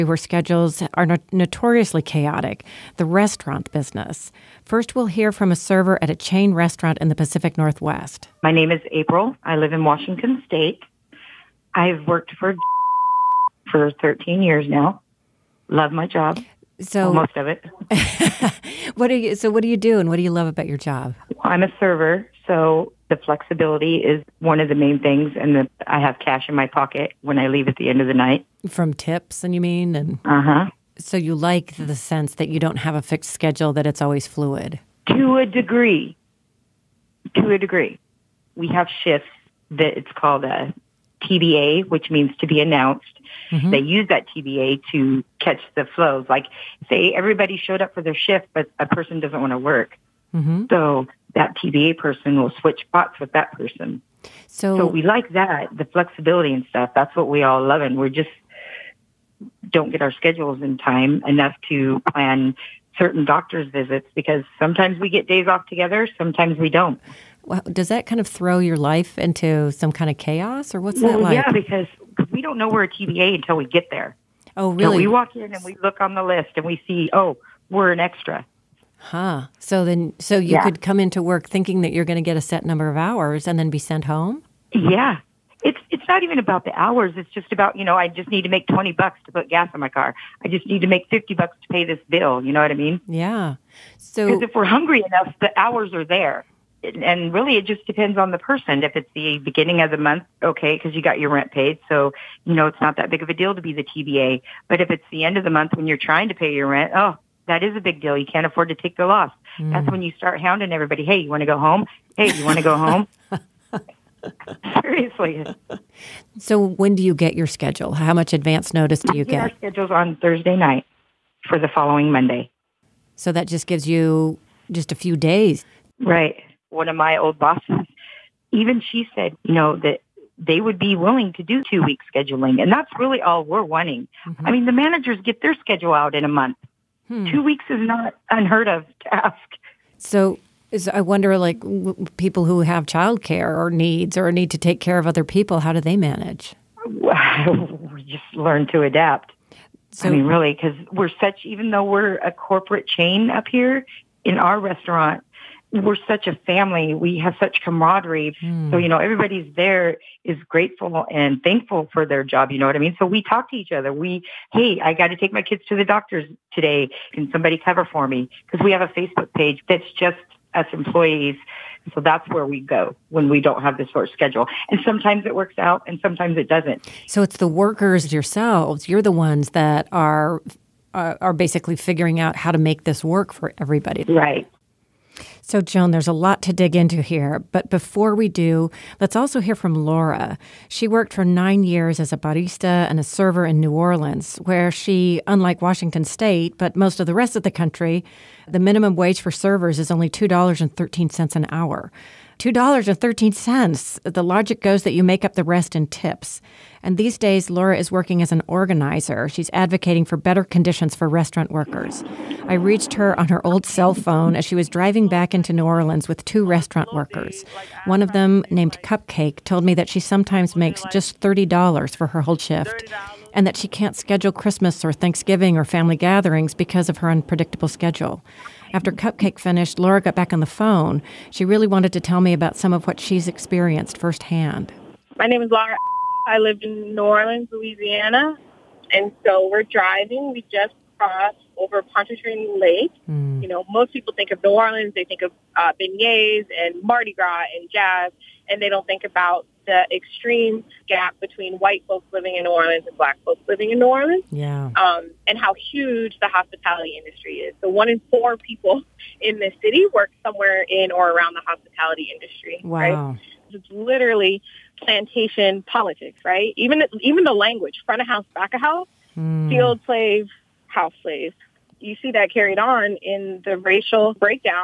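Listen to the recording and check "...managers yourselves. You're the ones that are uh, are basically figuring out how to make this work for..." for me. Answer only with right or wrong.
wrong.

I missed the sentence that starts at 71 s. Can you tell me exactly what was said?
Yeah, because we don't know we're a TBA until we get there.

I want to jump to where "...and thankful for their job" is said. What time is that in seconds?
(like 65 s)
161 s.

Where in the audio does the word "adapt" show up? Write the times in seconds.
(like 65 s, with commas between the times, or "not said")
148 s.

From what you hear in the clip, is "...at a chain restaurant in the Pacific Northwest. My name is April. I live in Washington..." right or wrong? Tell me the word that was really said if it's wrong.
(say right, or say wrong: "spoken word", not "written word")
right.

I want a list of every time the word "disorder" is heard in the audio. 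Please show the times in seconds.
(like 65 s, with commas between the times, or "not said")
not said.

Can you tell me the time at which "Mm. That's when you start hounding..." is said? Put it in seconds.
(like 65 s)
109 s.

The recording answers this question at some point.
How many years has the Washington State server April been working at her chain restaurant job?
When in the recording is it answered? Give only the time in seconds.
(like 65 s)
13 s.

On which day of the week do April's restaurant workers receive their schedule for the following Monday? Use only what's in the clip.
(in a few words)
Thursday.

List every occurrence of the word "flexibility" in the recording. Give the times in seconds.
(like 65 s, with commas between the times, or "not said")
23 s, 55 s.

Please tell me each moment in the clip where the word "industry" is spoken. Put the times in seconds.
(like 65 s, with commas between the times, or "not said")
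257 s, 262 s.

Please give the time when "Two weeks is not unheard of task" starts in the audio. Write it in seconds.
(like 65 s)
137 s.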